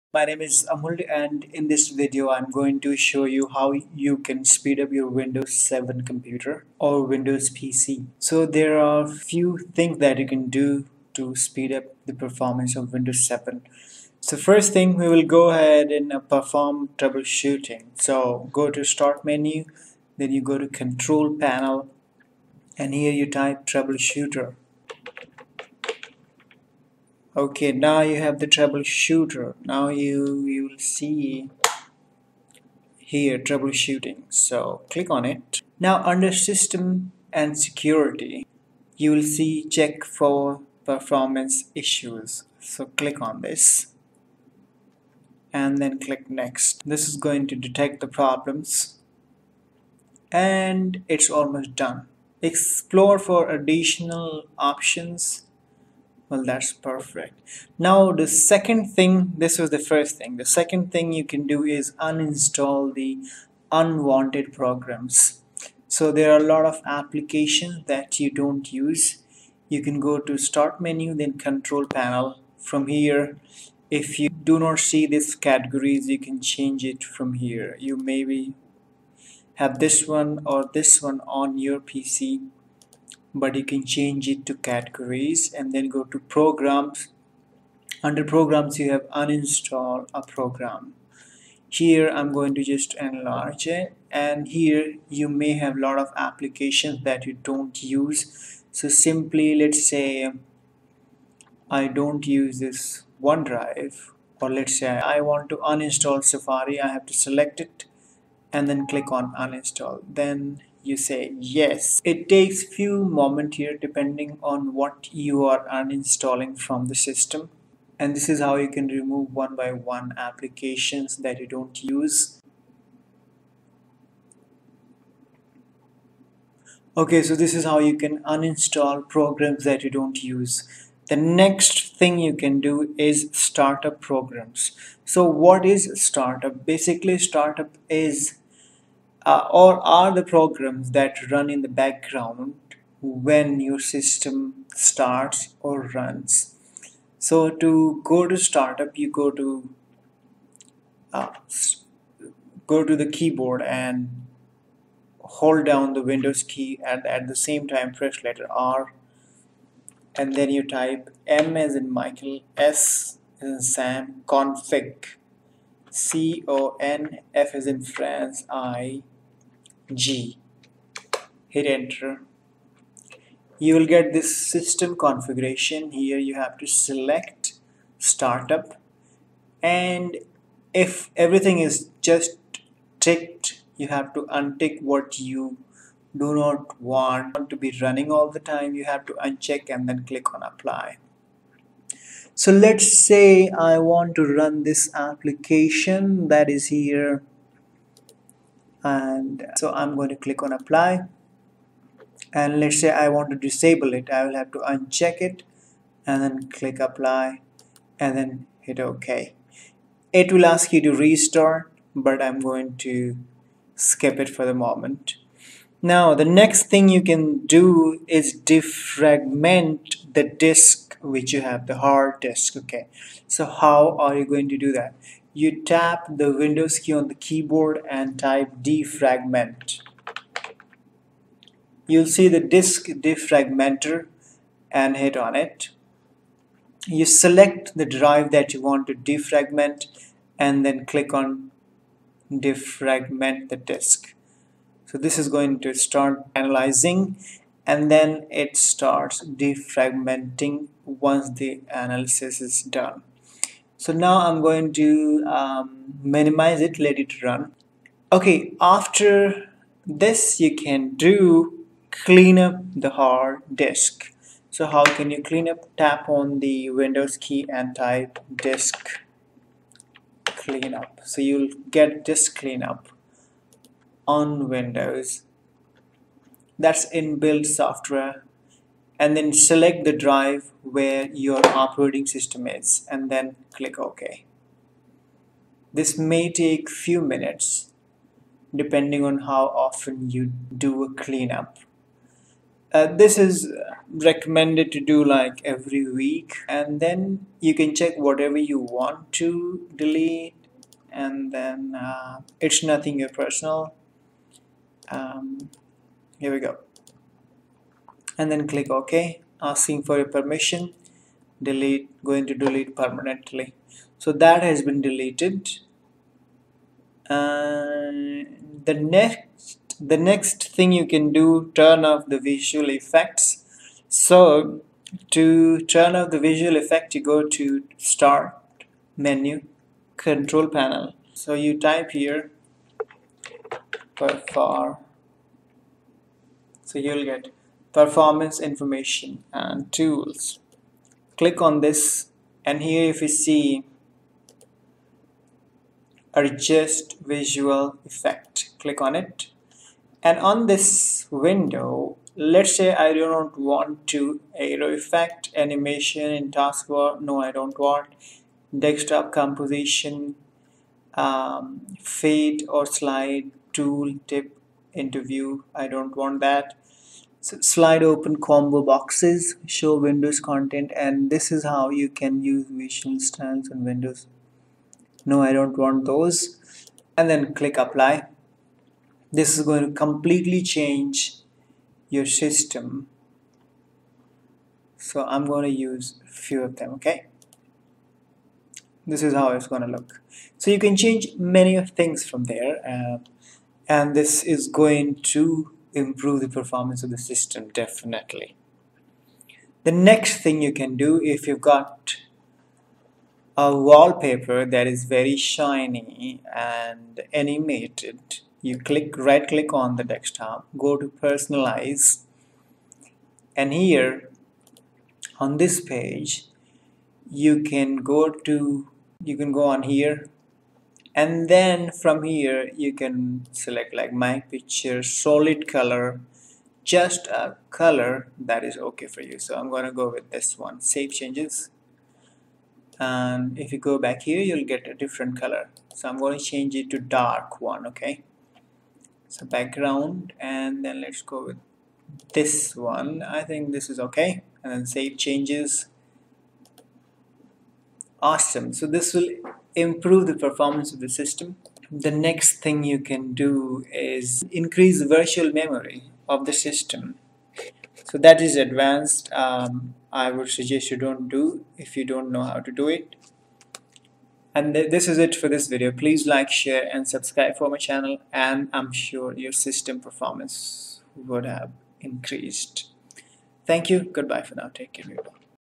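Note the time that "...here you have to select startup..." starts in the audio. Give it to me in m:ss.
2:55.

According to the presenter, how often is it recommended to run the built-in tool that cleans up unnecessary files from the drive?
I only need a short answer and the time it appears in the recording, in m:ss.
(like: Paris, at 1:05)
Every week, at 4:55.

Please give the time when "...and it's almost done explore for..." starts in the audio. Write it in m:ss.
0:50.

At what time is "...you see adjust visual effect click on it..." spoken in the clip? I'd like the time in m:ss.
5:43.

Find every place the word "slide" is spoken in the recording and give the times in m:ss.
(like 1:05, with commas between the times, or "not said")
6:02, 6:07.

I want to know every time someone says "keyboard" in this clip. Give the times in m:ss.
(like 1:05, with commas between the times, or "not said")
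2:33, 3:47.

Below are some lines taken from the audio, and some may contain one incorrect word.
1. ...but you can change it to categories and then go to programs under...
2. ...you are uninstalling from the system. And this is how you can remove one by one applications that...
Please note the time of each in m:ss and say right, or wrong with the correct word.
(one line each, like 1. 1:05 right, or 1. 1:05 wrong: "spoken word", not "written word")
1. 1:23 right
2. 1:55 right.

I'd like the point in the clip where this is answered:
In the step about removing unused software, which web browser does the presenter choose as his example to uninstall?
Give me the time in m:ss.
1:46.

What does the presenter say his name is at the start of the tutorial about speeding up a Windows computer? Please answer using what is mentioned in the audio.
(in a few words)
Amul.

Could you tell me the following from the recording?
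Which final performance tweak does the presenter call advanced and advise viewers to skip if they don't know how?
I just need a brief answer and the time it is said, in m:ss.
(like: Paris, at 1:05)
Increase virtual memory, at 7:34.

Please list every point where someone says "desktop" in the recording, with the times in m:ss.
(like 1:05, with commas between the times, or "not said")
5:58, 6:49.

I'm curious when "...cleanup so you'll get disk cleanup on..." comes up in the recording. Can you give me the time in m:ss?
4:30.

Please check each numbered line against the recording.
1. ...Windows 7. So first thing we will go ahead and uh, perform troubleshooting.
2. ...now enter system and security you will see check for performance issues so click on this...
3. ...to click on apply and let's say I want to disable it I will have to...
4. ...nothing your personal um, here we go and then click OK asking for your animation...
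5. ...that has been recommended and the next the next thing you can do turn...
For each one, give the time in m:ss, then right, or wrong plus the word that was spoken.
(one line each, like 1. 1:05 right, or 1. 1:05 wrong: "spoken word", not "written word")
1. 0:12 right
2. 0:35 wrong: "under", not "enter"
3. 3:20 right
4. 5:02 wrong: "permission", not "animation"
5. 5:14 wrong: "deleted", not "recommended".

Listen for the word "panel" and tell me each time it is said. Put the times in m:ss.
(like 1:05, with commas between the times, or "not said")
0:21, 1:11, 5:30.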